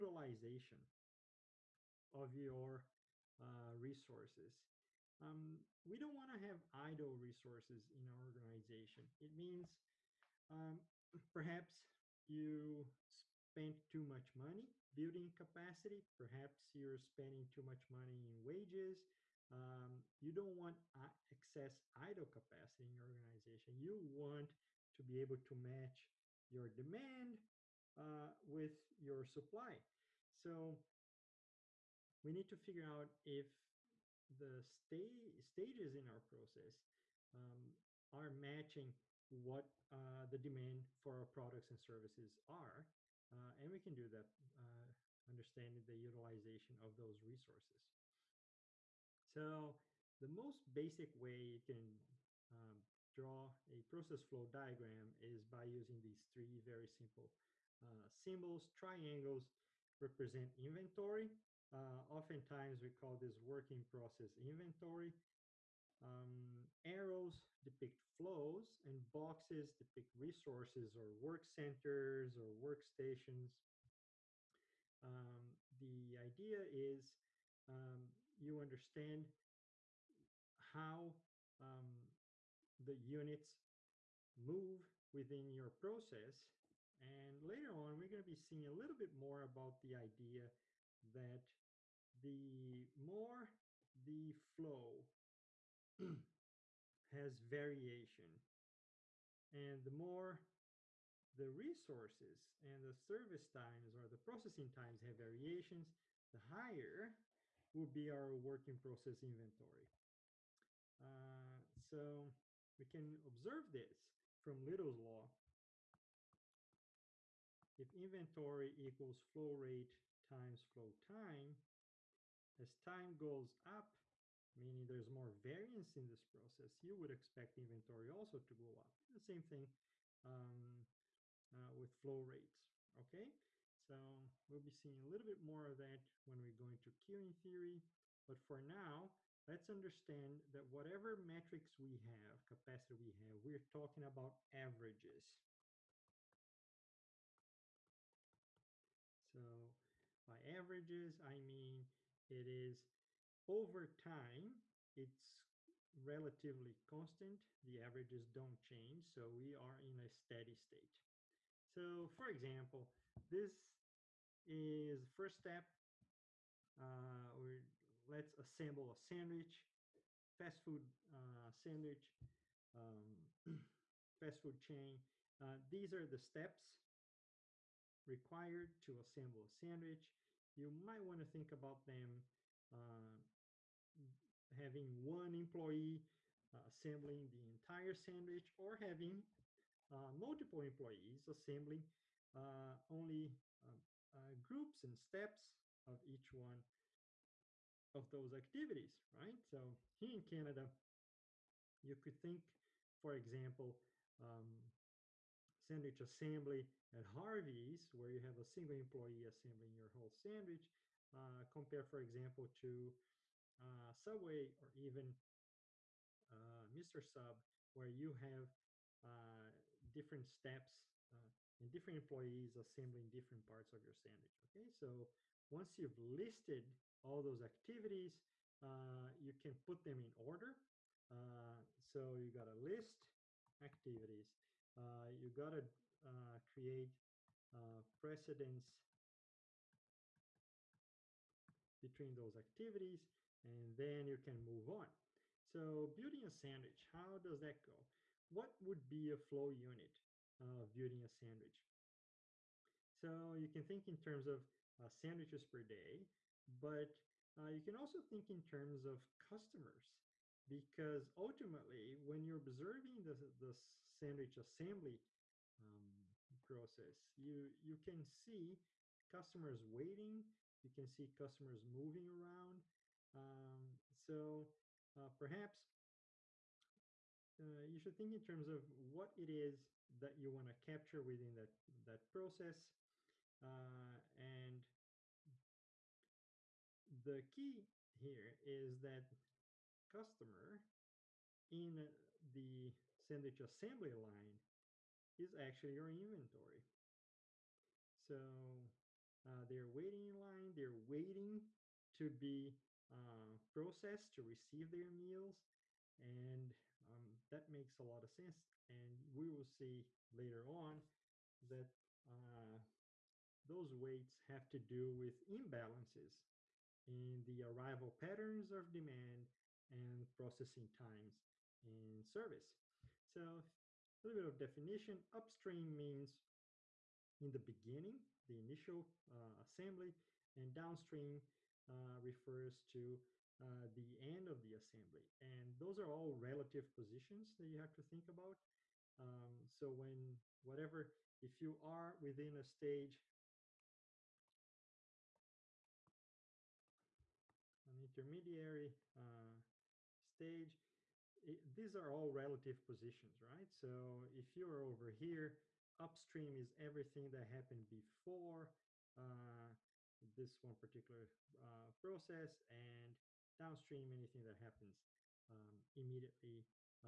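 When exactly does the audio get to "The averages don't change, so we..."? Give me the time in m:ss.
2:37.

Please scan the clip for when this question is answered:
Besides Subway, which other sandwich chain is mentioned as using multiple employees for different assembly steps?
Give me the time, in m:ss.
3:36.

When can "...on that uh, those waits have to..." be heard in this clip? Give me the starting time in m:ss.
5:10.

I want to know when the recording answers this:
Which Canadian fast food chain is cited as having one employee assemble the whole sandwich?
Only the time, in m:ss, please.
3:27.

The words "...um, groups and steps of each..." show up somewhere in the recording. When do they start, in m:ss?
3:13.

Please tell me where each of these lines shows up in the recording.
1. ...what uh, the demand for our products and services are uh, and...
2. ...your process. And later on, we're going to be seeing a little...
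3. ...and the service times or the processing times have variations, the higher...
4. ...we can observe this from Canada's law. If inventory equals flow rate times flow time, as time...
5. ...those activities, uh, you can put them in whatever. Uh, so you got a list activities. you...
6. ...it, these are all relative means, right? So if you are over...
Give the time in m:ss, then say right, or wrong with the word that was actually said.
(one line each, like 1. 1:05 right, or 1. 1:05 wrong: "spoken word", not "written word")
1. 0:39 right
2. 1:25 right
3. 1:42 right
4. 1:52 wrong: "Little", not "Canada"
5. 3:47 wrong: "order", not "whatever"
6. 5:51 wrong: "positions", not "means".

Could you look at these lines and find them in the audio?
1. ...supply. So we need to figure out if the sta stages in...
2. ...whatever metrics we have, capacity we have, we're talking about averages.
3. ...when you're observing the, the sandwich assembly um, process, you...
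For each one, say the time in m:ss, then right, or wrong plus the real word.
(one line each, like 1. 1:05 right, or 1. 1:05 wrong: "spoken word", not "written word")
1. 0:29 right
2. 2:20 right
3. 4:21 right.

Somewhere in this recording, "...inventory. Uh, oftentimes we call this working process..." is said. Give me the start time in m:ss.
1:00.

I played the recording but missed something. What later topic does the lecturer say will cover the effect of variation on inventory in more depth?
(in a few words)
Queuing theory.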